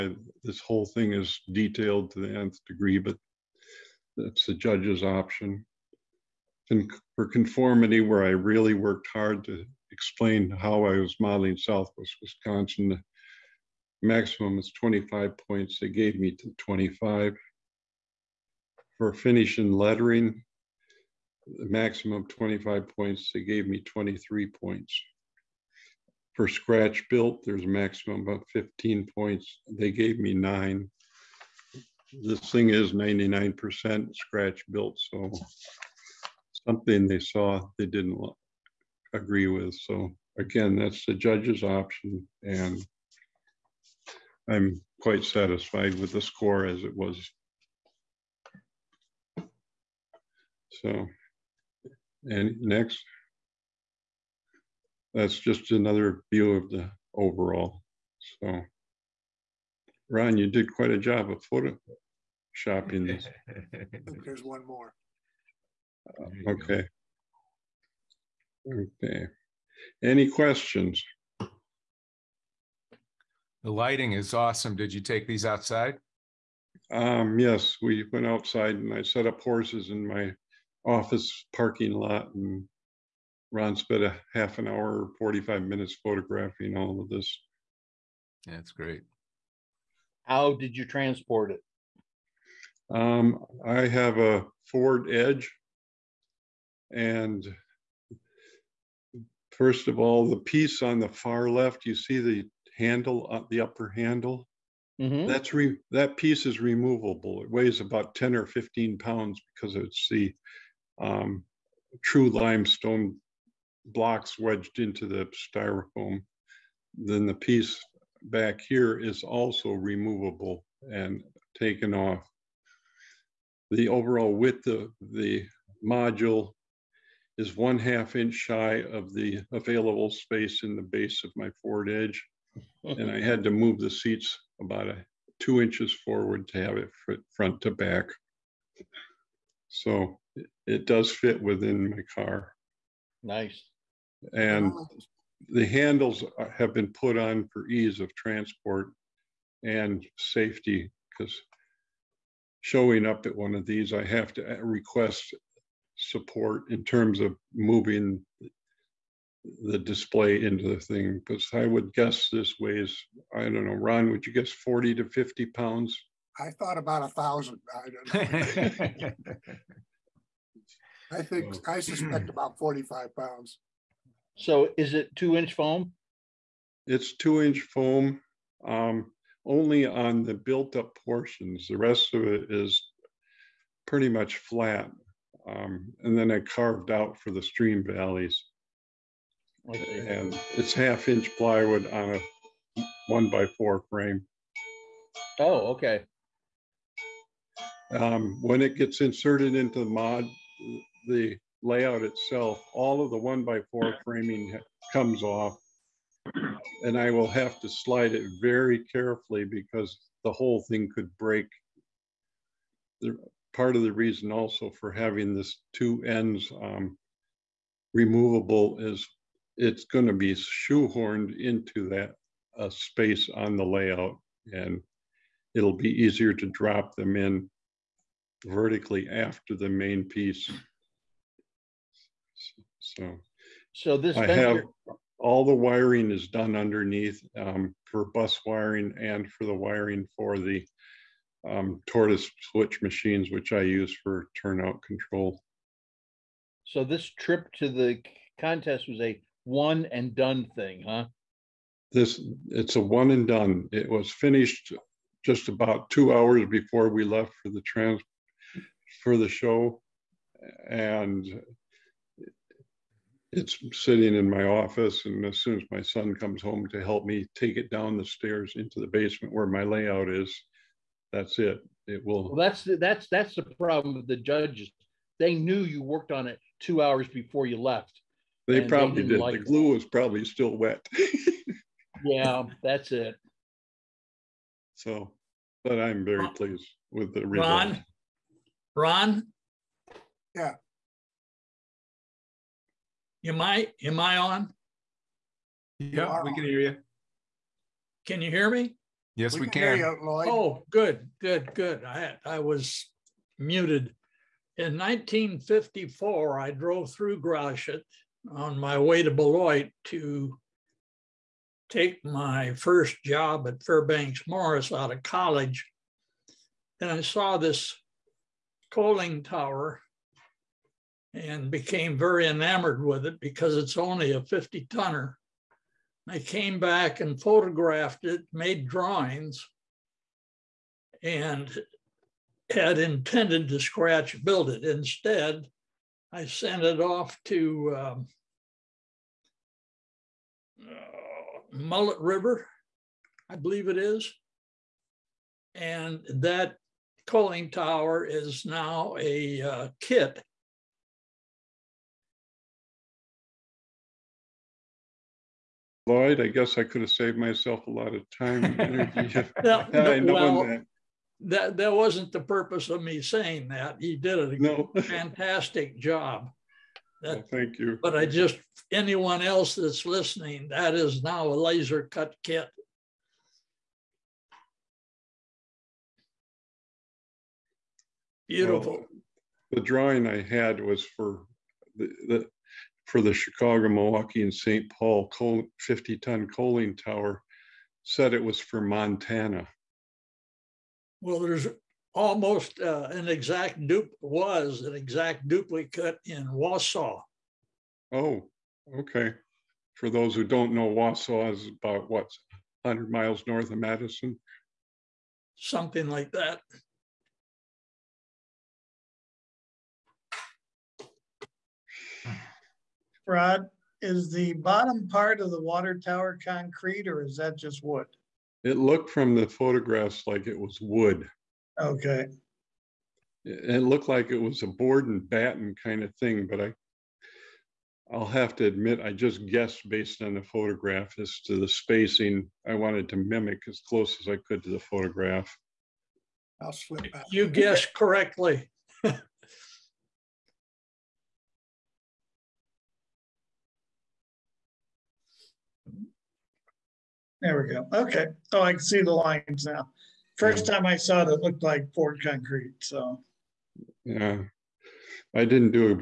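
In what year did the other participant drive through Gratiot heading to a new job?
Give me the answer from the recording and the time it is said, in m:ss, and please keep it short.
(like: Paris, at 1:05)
1954, at 5:04.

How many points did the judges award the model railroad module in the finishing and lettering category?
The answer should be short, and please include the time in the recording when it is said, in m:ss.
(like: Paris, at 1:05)
23, at 0:23.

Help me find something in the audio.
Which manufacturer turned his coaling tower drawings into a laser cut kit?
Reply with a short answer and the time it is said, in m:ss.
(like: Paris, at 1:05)
Mullet River, at 5:41.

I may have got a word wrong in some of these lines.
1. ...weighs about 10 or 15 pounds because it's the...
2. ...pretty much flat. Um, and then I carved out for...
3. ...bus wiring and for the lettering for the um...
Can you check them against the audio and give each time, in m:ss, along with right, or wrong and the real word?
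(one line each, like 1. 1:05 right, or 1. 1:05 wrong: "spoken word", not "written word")
1. 1:47 right
2. 3:03 right
3. 3:58 wrong: "wiring", not "lettering".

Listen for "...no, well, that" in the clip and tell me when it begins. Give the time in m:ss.
5:59.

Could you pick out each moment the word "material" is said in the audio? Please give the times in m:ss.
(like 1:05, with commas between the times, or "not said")
not said.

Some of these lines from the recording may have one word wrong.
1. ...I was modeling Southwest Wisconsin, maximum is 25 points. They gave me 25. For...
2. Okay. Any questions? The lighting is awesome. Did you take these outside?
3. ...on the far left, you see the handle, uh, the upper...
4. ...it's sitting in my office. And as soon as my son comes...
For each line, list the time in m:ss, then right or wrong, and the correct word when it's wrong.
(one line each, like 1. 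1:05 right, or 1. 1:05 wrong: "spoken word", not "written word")
1. 0:10 right
2. 1:08 right
3. 1:40 right
4. 4:23 right.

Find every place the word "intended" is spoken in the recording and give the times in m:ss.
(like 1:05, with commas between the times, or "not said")
5:32.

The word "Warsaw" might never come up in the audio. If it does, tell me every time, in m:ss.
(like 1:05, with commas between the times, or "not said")
6:36, 6:40.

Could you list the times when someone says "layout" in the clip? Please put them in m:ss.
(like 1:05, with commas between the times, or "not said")
3:21, 3:43, 4:29.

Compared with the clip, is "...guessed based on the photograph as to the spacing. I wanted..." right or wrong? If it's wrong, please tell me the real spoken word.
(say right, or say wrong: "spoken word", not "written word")
right.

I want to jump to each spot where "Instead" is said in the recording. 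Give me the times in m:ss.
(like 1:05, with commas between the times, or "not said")
5:34.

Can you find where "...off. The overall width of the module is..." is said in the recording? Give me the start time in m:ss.
2:01.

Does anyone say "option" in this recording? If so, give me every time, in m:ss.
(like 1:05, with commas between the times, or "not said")
0:05, 0:41.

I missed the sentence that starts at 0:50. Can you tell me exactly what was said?
So, and next, that's just another view of the overall.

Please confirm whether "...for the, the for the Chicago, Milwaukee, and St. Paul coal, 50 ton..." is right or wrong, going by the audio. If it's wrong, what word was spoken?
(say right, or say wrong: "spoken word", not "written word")
right.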